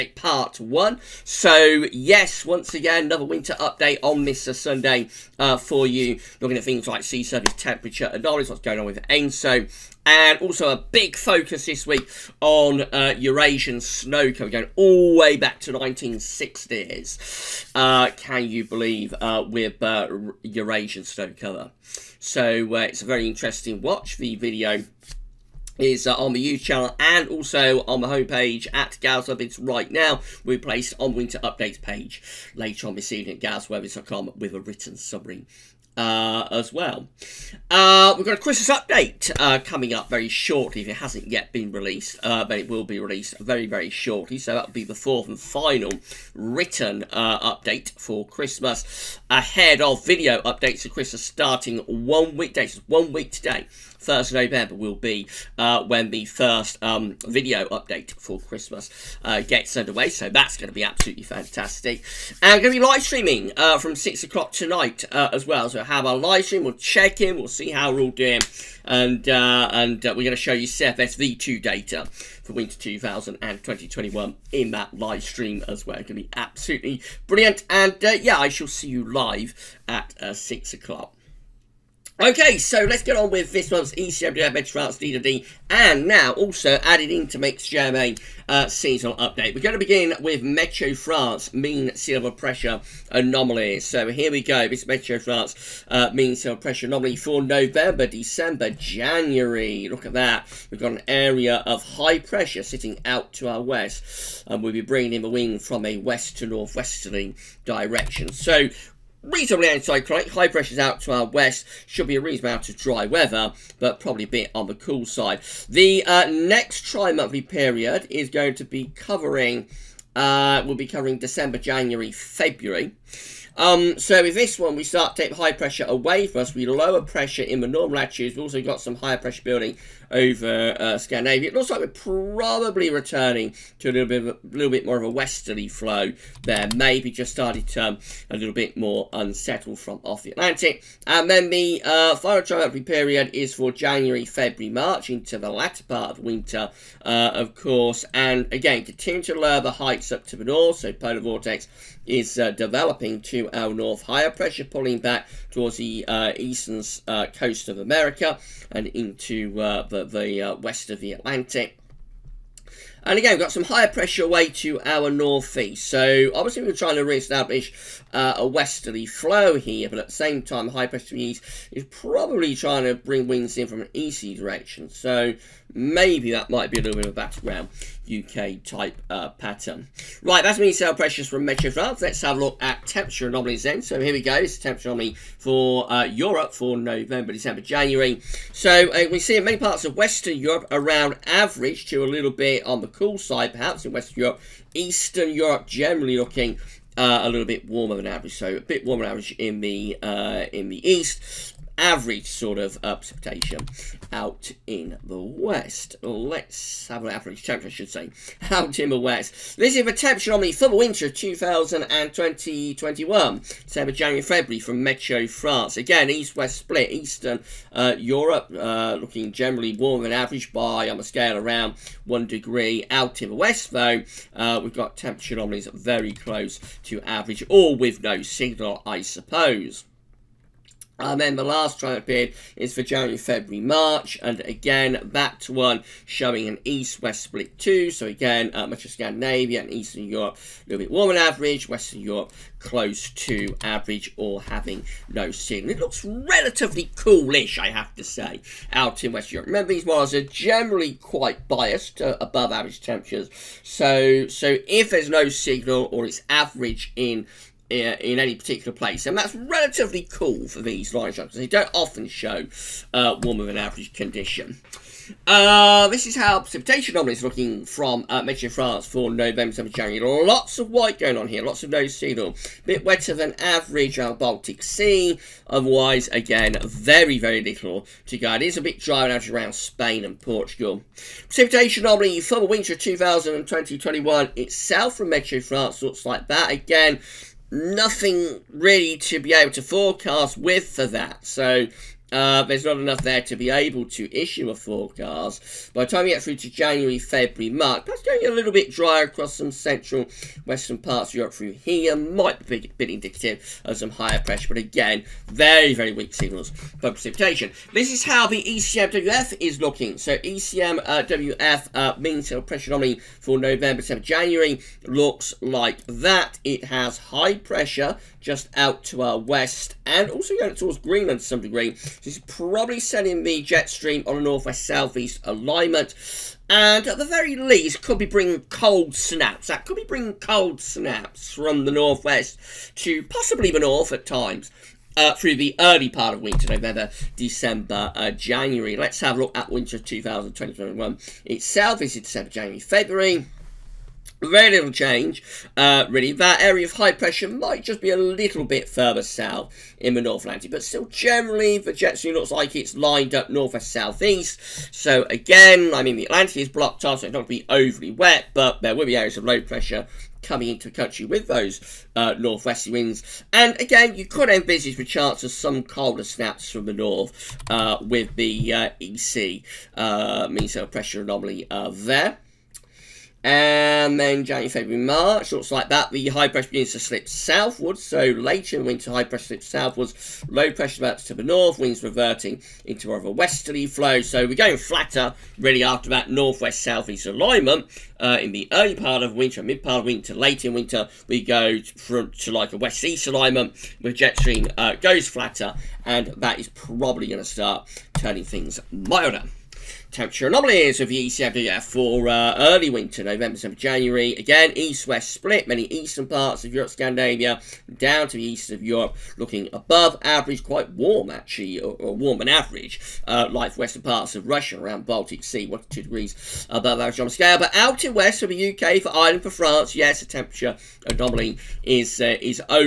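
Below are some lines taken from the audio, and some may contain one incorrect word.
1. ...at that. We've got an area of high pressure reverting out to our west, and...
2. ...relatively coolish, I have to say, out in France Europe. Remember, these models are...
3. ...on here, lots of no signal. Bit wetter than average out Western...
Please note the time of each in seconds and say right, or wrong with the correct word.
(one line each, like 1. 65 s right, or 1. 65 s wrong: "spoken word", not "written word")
1. 100 s wrong: "sitting", not "reverting"
2. 246 s wrong: "Western", not "France"
3. 271 s wrong: "Baltic", not "Western".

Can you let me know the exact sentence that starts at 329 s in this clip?
That could be bringing cold snaps from the northwest to possibly the north at times.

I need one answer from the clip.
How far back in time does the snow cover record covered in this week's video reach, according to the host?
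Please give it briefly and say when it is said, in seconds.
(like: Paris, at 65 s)
1960, at 15 s.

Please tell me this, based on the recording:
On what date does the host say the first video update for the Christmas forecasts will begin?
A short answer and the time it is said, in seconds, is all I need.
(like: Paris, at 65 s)
1st November, at 54 s.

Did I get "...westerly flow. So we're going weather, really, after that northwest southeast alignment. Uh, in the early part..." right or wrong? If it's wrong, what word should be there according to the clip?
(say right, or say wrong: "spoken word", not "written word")
wrong: "flatter", not "weather".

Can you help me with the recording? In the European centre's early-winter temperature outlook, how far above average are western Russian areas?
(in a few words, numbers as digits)
1 to 2 degrees.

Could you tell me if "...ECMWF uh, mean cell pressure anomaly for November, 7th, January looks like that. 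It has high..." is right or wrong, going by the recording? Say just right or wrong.
right.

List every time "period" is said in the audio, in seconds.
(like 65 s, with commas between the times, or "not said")
117 s, 142 s, 232 s.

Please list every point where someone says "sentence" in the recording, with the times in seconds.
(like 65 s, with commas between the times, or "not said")
not said.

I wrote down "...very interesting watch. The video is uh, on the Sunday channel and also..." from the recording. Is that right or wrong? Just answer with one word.
wrong.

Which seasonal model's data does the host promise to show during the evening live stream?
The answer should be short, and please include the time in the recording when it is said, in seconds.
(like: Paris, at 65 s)
CFSV2, at 70 s.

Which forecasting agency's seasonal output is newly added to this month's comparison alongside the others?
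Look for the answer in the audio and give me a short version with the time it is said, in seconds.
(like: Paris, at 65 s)
JMA, at 87 s.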